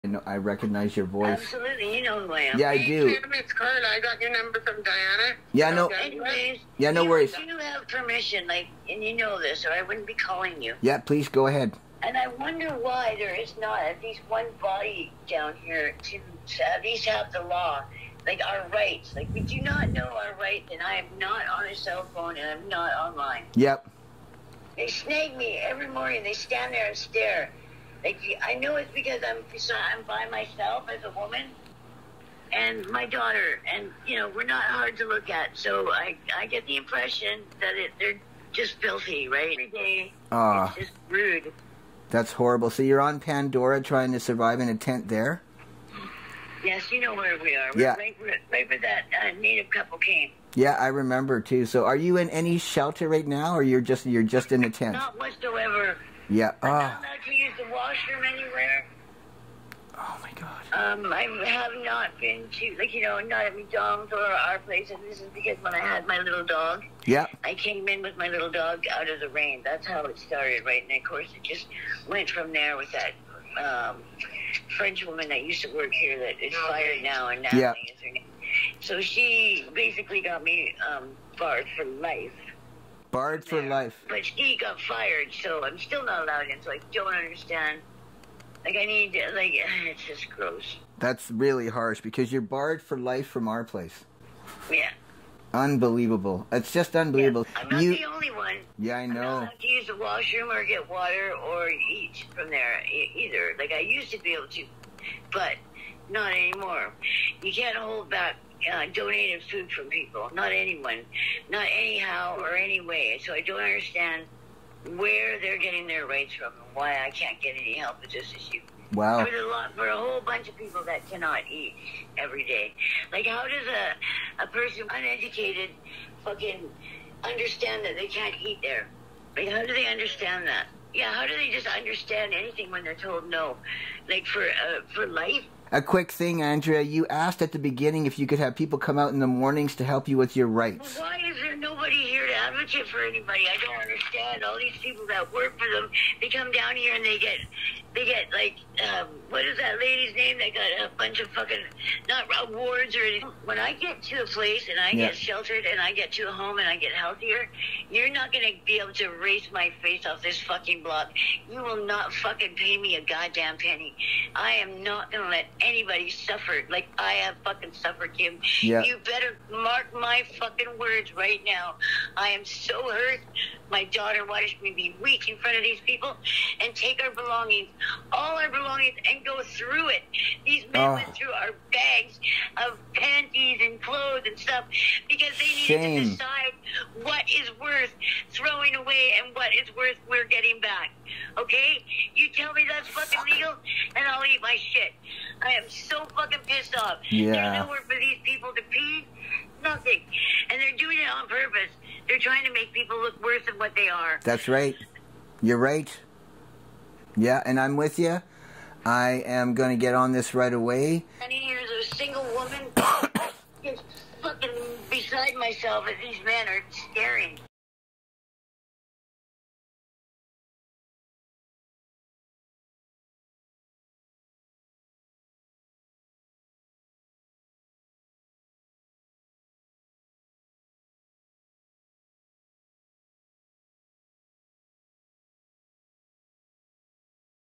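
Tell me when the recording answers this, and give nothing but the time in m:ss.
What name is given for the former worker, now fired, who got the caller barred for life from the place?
1:17.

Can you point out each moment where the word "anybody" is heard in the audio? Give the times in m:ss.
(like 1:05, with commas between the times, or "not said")
2:23, 2:45.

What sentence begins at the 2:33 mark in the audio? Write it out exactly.
When I get to a place and I yeah.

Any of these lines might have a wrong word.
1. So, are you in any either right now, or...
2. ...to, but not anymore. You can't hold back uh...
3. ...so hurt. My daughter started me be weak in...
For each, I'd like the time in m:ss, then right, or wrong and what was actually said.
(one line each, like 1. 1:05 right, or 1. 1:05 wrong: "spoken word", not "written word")
1. 0:51 wrong: "shelter", not "either"
2. 1:44 right
3. 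2:52 wrong: "watched", not "started".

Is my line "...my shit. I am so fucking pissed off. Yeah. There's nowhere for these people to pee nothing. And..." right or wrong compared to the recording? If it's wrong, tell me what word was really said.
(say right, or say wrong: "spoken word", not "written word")
right.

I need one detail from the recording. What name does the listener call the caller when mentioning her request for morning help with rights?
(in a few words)
Andrea.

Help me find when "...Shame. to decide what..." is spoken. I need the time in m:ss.
3:05.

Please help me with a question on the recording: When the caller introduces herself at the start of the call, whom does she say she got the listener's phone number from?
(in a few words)
Diana.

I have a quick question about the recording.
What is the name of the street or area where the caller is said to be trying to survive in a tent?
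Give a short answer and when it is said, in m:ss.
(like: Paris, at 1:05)
Pandora, at 0:43.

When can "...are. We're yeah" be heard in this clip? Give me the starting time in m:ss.
0:47.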